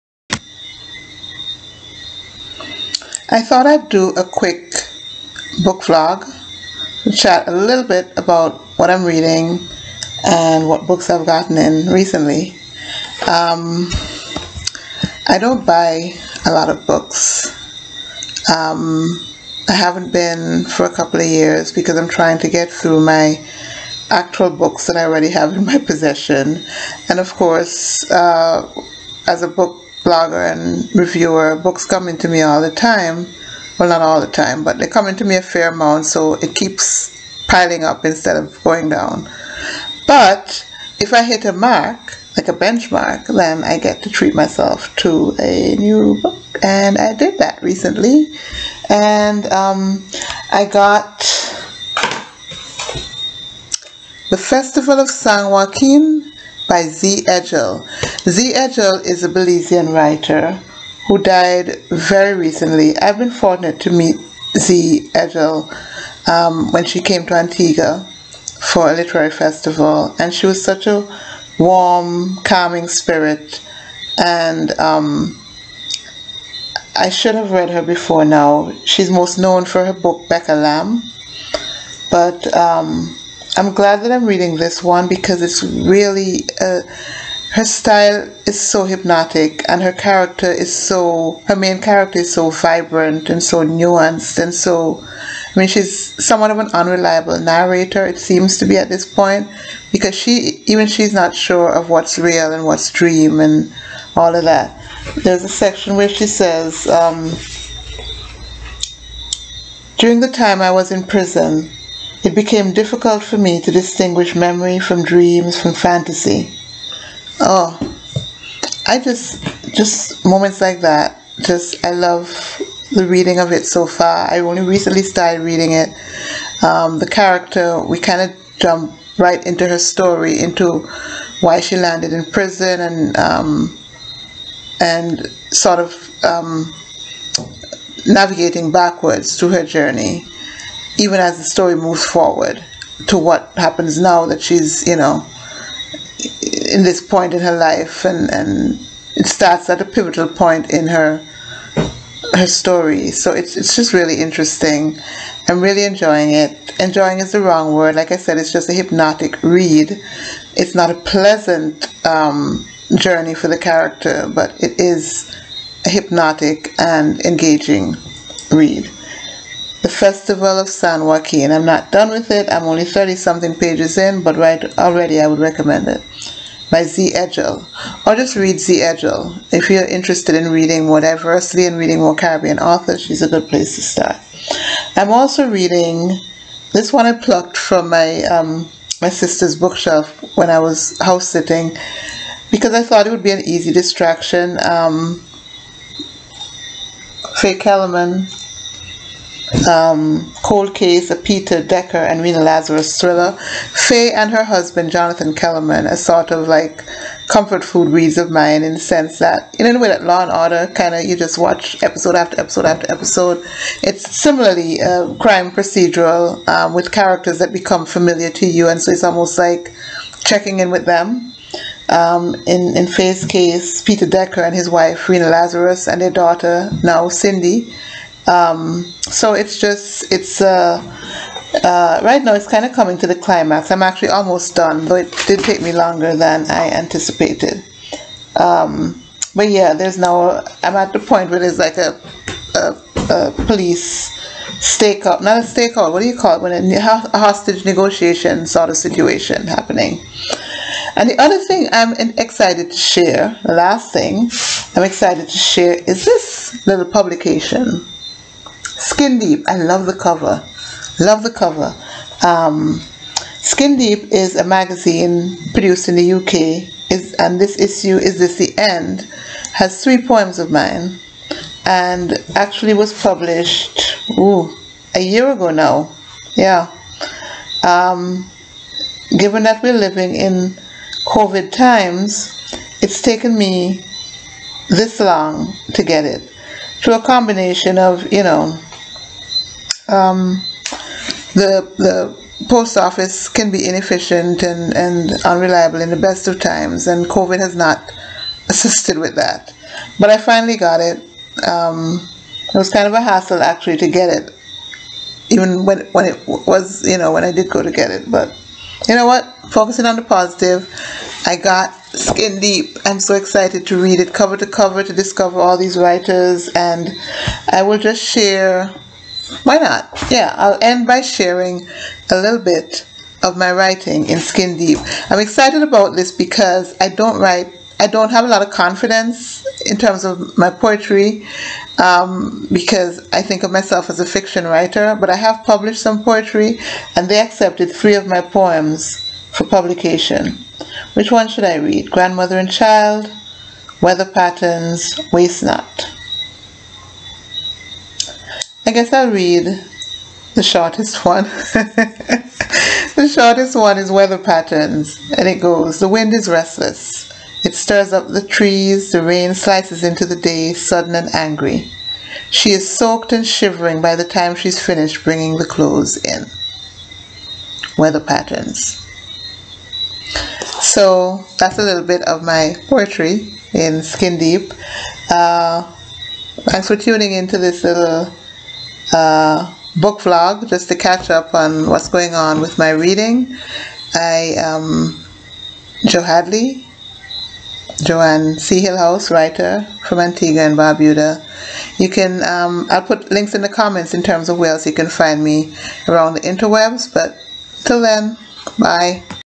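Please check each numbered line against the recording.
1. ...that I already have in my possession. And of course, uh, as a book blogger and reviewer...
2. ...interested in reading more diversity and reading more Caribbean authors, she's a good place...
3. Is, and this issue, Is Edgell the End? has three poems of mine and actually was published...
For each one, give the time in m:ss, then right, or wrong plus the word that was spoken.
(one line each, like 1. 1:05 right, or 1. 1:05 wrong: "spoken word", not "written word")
1. 0:24 right
2. 2:59 right
3. 4:26 wrong: "This", not "Edgell".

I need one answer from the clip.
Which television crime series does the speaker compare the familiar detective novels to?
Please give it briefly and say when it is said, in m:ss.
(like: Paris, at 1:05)
Law and Order, at 3:30.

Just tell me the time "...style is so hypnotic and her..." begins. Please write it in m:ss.
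1:27.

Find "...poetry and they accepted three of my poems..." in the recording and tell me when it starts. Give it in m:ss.
5:36.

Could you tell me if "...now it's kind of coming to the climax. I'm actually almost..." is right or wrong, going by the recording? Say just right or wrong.
right.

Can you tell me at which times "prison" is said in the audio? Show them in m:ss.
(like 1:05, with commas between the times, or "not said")
1:51, 2:12.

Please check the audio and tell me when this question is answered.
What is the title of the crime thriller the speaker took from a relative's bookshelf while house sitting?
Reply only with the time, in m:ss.
3:20.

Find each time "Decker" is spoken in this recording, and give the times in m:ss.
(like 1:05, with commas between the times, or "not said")
3:21, 3:44.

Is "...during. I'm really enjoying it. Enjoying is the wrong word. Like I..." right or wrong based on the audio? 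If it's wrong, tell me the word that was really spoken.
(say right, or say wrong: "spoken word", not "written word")
wrong: "interesting", not "during".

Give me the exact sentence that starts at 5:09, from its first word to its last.
Focusing on the positive, I got Skin Deep.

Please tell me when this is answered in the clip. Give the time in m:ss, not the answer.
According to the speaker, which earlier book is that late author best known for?
1:20.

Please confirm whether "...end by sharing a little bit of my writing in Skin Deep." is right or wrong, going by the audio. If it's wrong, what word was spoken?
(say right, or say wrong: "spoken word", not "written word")
right.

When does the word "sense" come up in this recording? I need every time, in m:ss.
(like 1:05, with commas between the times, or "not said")
3:28.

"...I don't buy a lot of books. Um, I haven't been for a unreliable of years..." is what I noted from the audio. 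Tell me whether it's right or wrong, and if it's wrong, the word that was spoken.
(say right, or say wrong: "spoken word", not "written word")
wrong: "couple", not "unreliable".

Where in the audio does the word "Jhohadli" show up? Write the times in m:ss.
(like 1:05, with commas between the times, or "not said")
6:25.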